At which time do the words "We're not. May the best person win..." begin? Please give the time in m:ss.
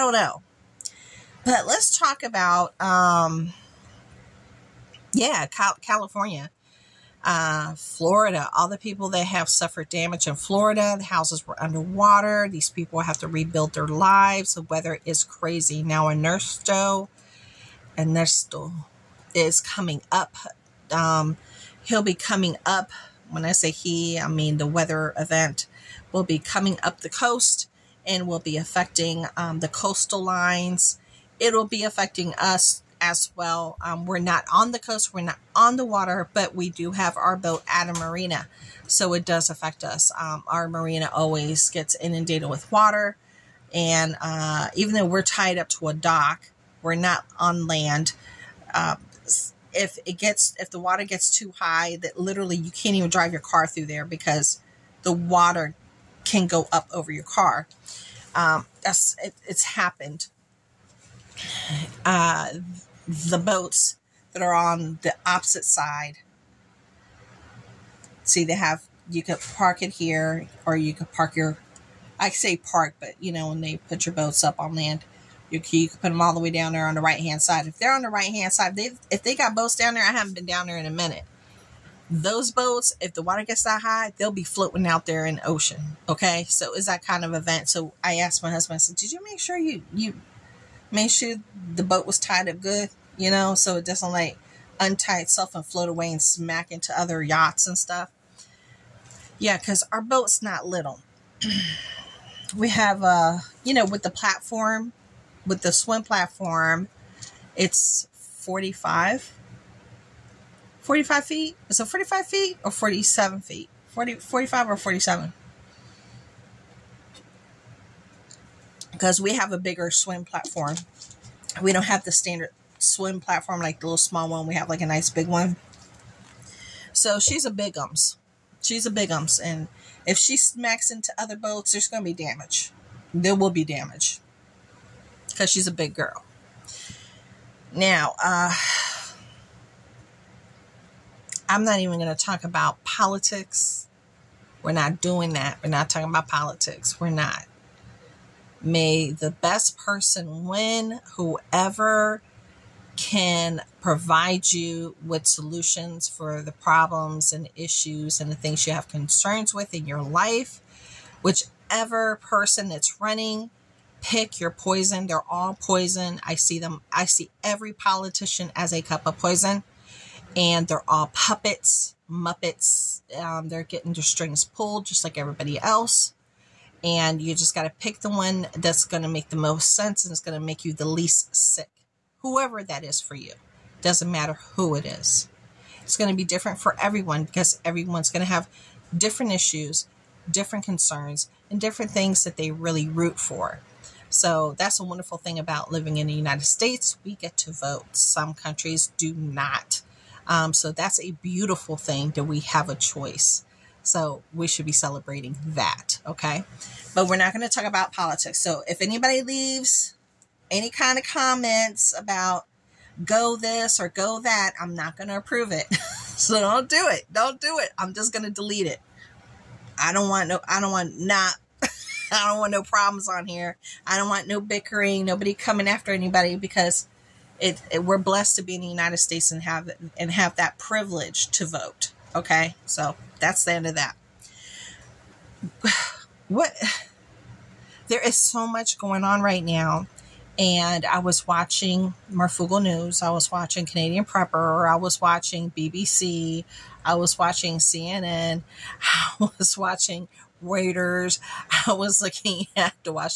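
2:27.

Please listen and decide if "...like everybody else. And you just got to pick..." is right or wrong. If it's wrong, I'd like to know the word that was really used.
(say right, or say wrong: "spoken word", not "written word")
right.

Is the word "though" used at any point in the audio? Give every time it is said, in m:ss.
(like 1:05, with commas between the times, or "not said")
0:44.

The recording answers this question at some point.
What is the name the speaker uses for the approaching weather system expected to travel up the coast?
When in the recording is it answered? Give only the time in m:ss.
0:17.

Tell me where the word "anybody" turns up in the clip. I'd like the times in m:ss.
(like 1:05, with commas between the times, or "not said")
3:28, 3:45.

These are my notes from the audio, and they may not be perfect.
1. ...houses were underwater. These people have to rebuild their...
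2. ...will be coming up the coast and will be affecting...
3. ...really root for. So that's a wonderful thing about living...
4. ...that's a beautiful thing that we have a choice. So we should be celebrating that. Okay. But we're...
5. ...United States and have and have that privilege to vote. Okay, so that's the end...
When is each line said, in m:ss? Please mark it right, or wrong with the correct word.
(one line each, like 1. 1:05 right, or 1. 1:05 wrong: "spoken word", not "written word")
1. 0:11 right
2. 0:26 right
3. 3:12 right
4. 3:20 right
5. 3:48 right.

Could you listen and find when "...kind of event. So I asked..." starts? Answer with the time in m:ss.
1:27.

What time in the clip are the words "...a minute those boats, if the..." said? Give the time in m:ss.
1:20.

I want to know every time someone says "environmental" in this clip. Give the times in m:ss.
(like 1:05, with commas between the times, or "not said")
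not said.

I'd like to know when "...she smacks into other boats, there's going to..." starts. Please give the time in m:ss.
2:10.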